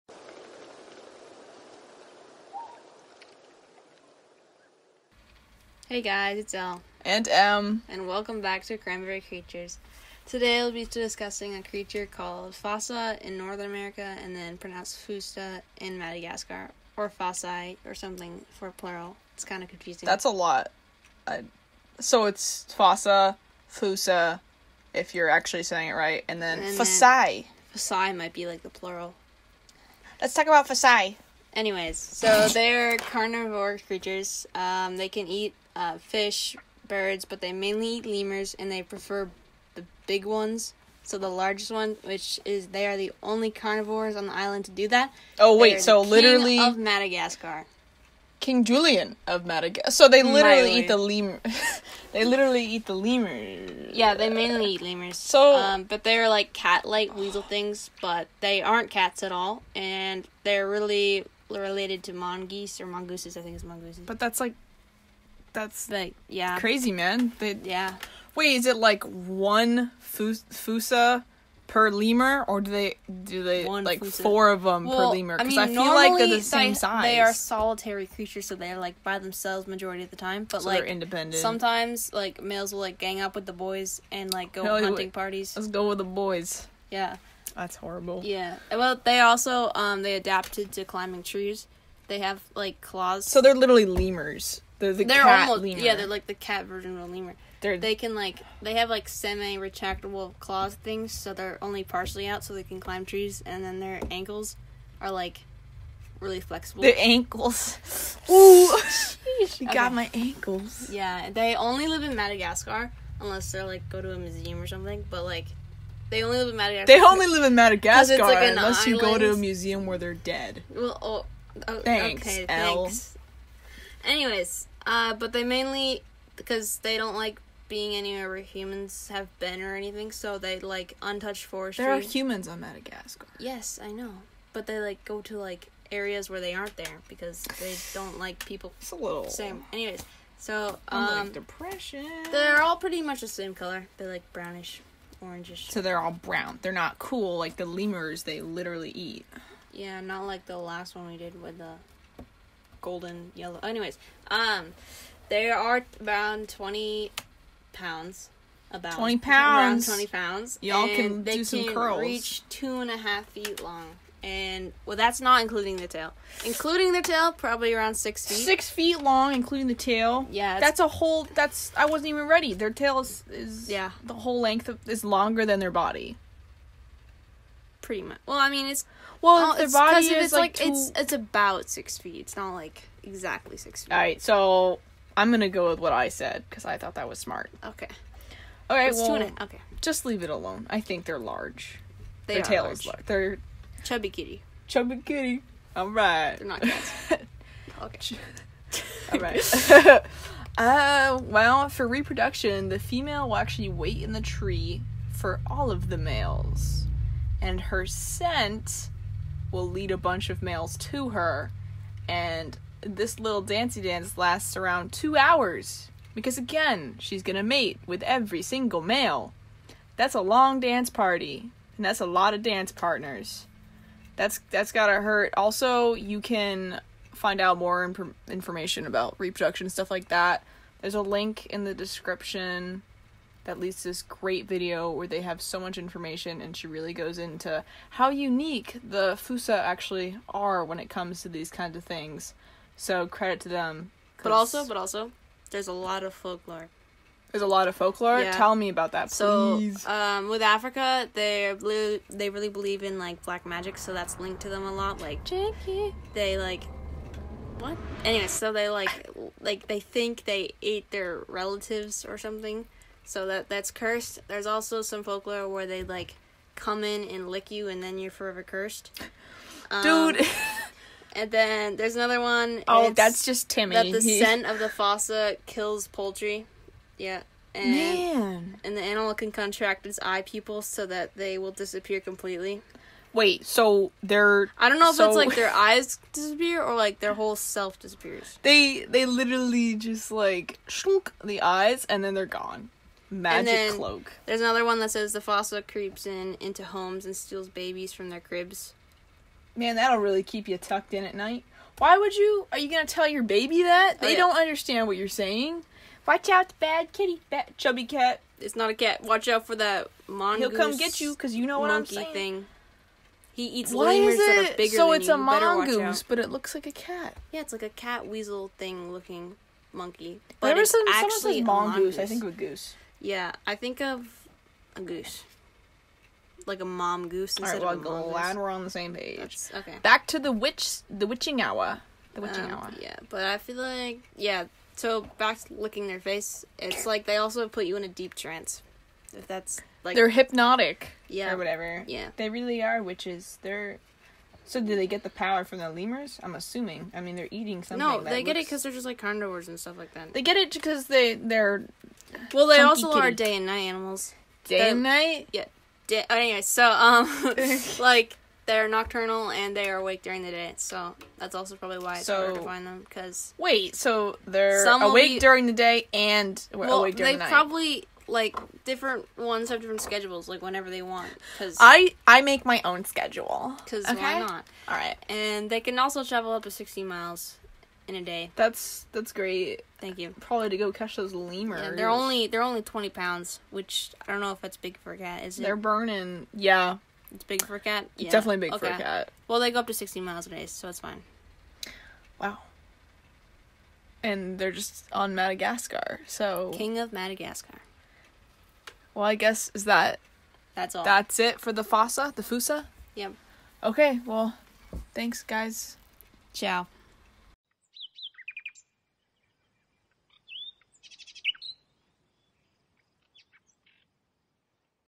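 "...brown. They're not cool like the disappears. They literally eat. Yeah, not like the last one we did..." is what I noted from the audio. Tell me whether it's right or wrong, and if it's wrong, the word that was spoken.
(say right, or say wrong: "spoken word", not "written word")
wrong: "lemurs", not "disappears".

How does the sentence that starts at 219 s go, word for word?
That's a long dance party, and that's a lot of dance partners.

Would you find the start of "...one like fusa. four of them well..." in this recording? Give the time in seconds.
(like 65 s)
73 s.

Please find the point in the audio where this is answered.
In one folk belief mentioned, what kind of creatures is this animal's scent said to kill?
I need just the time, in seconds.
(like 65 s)
273 s.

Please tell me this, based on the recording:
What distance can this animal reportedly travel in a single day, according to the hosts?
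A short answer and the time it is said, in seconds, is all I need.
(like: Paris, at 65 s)
60 miles, at 376 s.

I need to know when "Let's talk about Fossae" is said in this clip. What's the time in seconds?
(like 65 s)
30 s.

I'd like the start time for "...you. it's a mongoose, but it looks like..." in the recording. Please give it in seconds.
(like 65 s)
314 s.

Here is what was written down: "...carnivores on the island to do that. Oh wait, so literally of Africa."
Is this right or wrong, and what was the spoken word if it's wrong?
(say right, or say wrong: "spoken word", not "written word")
wrong: "Madagascar", not "Africa".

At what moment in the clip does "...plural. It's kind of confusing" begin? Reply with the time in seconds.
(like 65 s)
18 s.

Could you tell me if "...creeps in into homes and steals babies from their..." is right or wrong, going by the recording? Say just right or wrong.
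right.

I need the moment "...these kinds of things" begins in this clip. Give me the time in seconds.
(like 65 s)
241 s.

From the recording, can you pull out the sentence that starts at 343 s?
They're so do they get the power from the lemurs?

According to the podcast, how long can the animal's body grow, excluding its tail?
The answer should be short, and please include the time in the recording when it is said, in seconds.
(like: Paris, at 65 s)
2.5 feet, at 161 s.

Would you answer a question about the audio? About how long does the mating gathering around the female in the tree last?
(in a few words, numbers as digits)
2 hours.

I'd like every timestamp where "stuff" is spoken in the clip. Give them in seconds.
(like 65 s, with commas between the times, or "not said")
229 s, 349 s.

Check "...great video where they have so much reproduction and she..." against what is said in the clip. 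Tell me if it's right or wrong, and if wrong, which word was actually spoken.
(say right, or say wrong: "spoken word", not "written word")
wrong: "information", not "reproduction".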